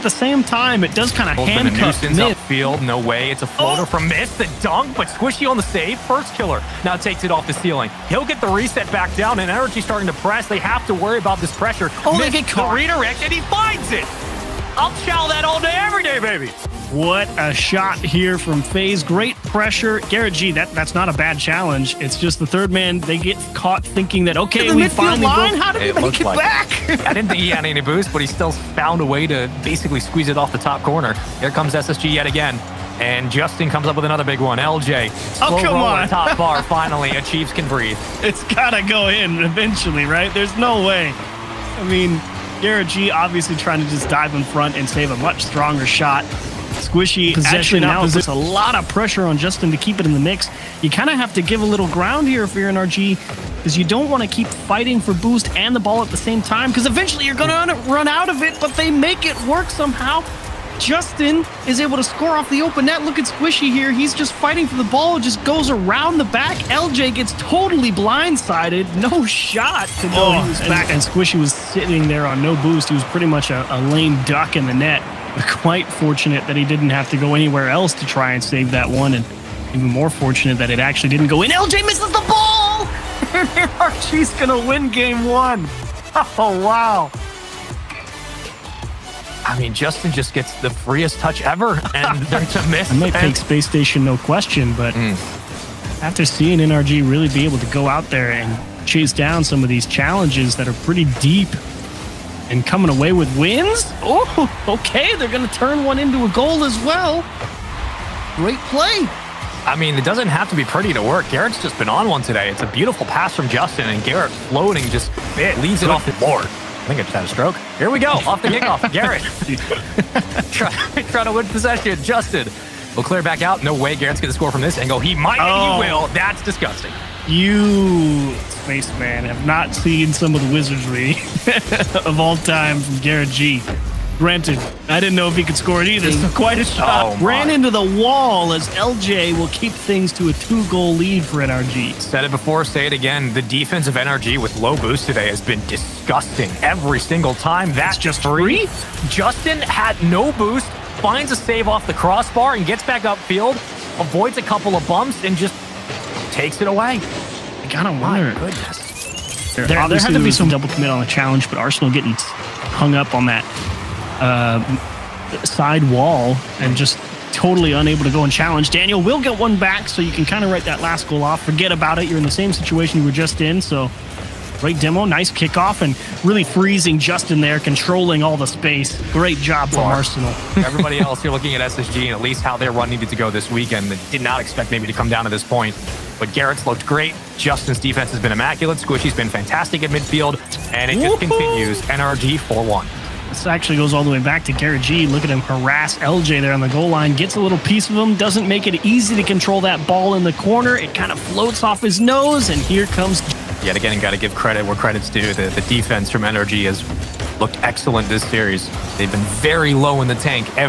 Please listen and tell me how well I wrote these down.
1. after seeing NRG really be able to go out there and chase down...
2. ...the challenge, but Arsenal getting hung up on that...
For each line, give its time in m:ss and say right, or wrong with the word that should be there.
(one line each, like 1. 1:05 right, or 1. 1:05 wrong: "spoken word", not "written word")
1. 1:36 right
2. 2:41 right.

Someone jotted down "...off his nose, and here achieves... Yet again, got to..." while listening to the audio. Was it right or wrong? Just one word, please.
wrong.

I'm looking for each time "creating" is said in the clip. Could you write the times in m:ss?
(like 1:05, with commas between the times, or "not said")
not said.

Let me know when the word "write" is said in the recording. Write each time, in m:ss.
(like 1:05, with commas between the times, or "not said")
2:50.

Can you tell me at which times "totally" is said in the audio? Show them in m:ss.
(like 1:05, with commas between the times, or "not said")
1:07, 2:47.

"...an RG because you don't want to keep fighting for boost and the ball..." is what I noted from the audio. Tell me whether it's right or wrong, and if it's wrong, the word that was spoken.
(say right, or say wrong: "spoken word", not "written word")
right.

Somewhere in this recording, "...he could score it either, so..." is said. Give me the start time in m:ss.
2:15.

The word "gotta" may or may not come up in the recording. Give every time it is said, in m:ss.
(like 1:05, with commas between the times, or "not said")
0:38, 2:37.